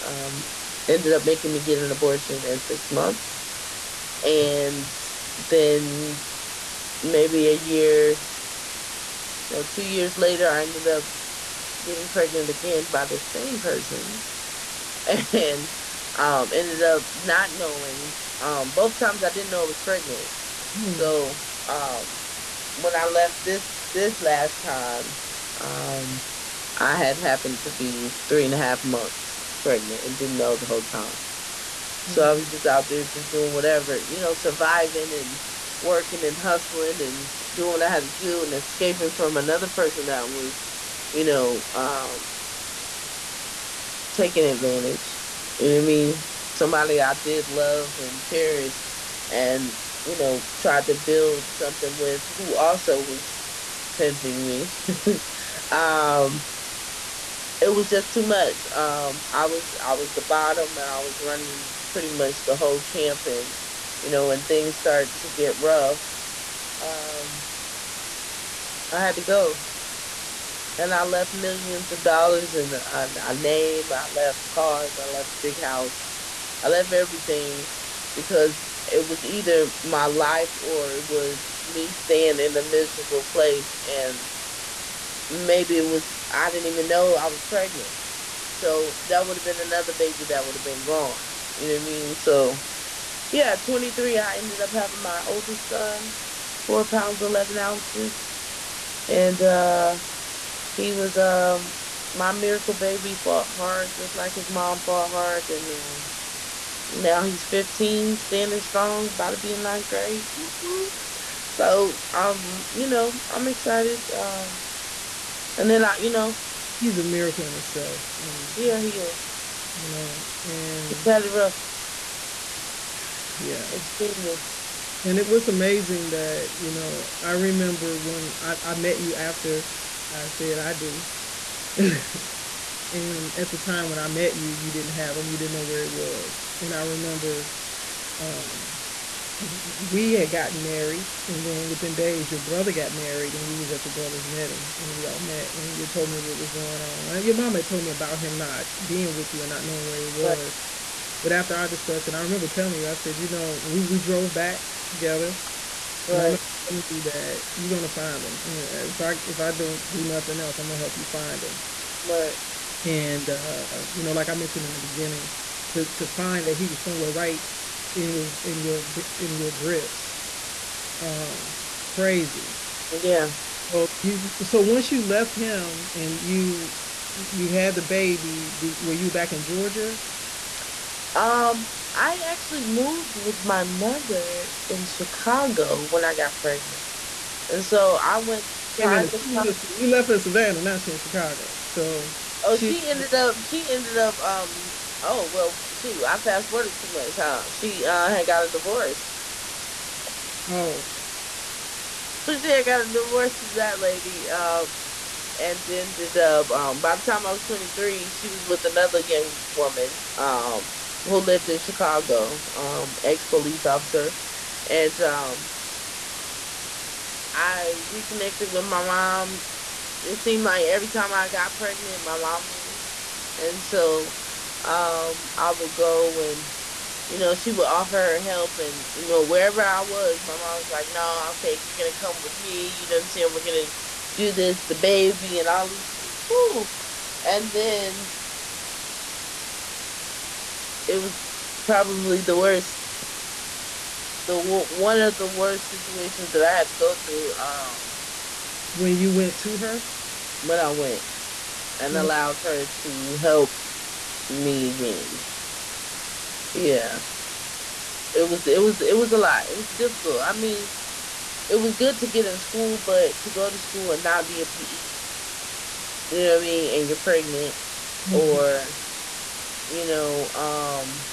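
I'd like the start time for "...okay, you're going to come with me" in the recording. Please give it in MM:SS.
03:51.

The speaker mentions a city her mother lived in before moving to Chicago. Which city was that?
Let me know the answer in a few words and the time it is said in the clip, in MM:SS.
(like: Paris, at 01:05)
Savannah, at 03:10.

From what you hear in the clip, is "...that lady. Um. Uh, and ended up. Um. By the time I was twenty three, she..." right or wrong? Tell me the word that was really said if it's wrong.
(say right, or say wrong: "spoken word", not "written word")
right.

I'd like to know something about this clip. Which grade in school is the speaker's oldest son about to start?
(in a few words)
ninth grade.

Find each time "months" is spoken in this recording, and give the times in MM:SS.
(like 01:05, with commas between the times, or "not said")
00:02, 00:28.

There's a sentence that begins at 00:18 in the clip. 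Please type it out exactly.
Um, both times I didn't know I was pregnant Hmm.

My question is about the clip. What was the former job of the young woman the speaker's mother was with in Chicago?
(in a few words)
police officer.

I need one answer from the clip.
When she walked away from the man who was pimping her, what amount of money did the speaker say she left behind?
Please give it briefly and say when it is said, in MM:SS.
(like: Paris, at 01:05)
millions of dollars, at 01:11.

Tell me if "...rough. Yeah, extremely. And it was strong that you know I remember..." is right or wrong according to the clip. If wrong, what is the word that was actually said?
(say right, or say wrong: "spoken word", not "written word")
wrong: "amazing", not "strong".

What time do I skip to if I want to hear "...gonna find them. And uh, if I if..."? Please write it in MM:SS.
02:37.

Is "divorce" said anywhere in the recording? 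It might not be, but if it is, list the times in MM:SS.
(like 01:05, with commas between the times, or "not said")
03:18, 03:22.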